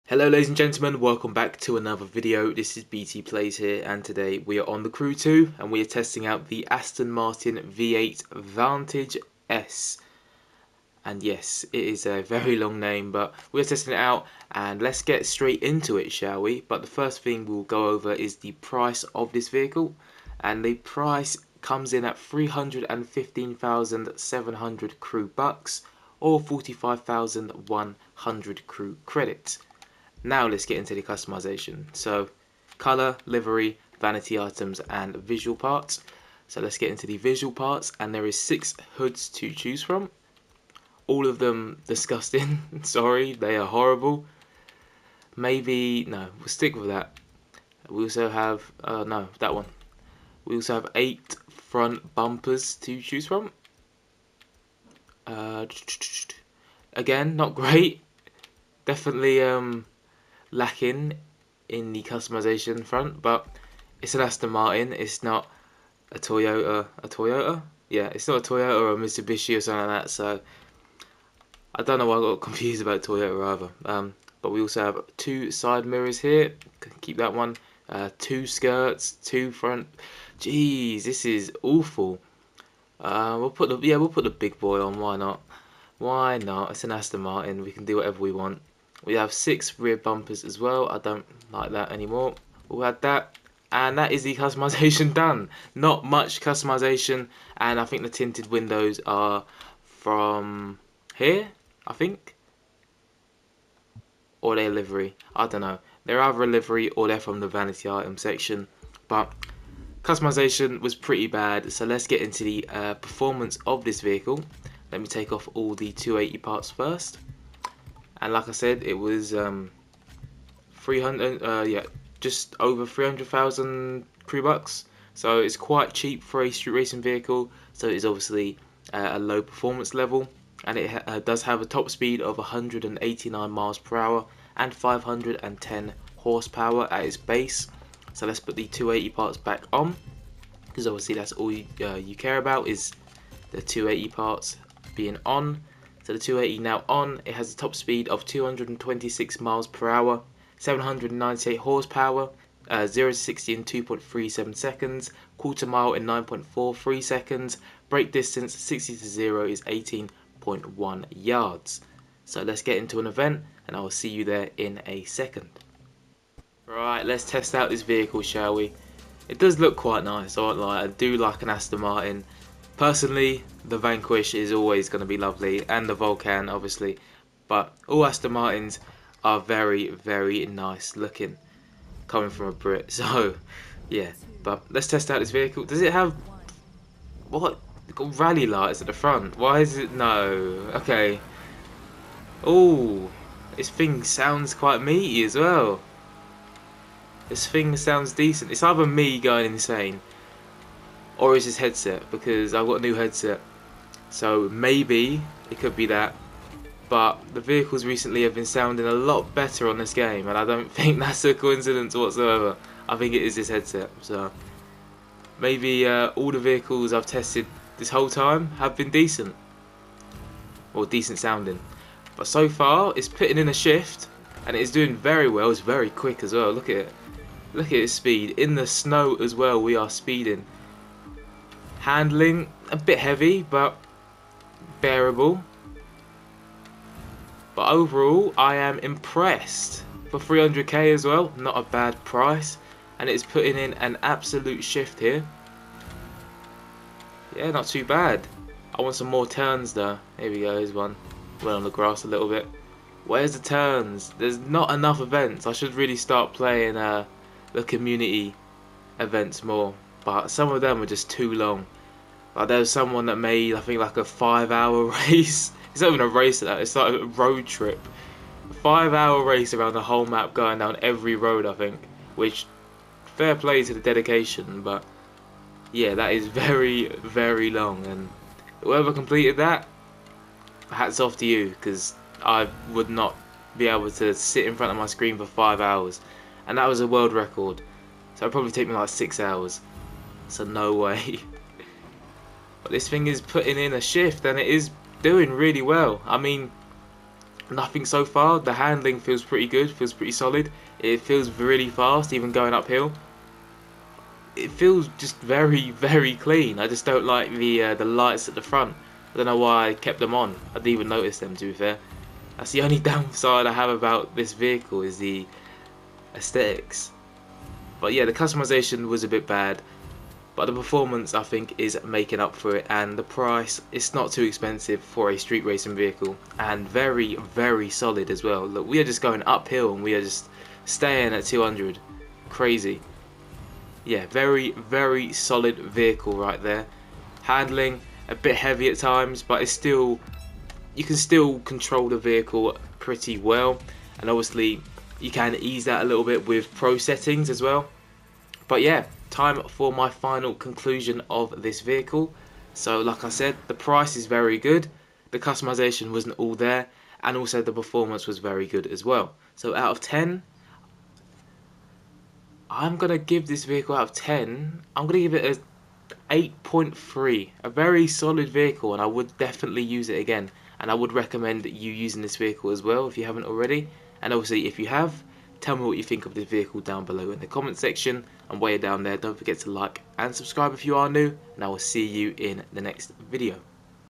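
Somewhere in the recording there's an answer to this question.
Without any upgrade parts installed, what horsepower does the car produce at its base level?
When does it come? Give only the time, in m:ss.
2:14.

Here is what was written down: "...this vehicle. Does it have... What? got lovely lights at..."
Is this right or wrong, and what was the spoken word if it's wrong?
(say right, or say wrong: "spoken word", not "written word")
wrong: "rally", not "lovely".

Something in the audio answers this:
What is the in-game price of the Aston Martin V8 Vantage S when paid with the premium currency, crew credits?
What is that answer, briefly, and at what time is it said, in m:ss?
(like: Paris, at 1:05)
45,100 crew credits, at 0:26.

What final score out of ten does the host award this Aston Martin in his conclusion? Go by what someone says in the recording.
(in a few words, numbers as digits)
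8.3.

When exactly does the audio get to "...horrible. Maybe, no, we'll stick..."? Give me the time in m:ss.
0:43.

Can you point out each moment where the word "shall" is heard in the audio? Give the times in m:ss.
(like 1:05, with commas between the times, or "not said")
0:16, 2:48.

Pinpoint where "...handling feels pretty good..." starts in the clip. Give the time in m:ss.
4:58.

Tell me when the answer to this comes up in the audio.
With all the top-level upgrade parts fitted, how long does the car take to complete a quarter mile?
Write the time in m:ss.
2:36.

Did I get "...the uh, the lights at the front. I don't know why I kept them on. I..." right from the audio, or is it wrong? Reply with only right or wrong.
right.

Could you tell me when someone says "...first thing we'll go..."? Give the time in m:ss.
0:16.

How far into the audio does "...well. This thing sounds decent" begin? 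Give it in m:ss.
3:15.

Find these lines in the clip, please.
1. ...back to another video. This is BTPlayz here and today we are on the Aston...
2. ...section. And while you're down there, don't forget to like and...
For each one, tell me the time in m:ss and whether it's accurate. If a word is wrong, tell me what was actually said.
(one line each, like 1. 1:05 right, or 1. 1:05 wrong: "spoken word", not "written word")
1. 0:01 wrong: "Crew", not "Aston"
2. 6:17 right.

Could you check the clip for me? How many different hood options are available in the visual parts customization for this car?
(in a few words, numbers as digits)
6.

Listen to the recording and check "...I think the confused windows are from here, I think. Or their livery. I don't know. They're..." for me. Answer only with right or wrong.
wrong.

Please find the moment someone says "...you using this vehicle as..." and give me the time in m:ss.
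6:11.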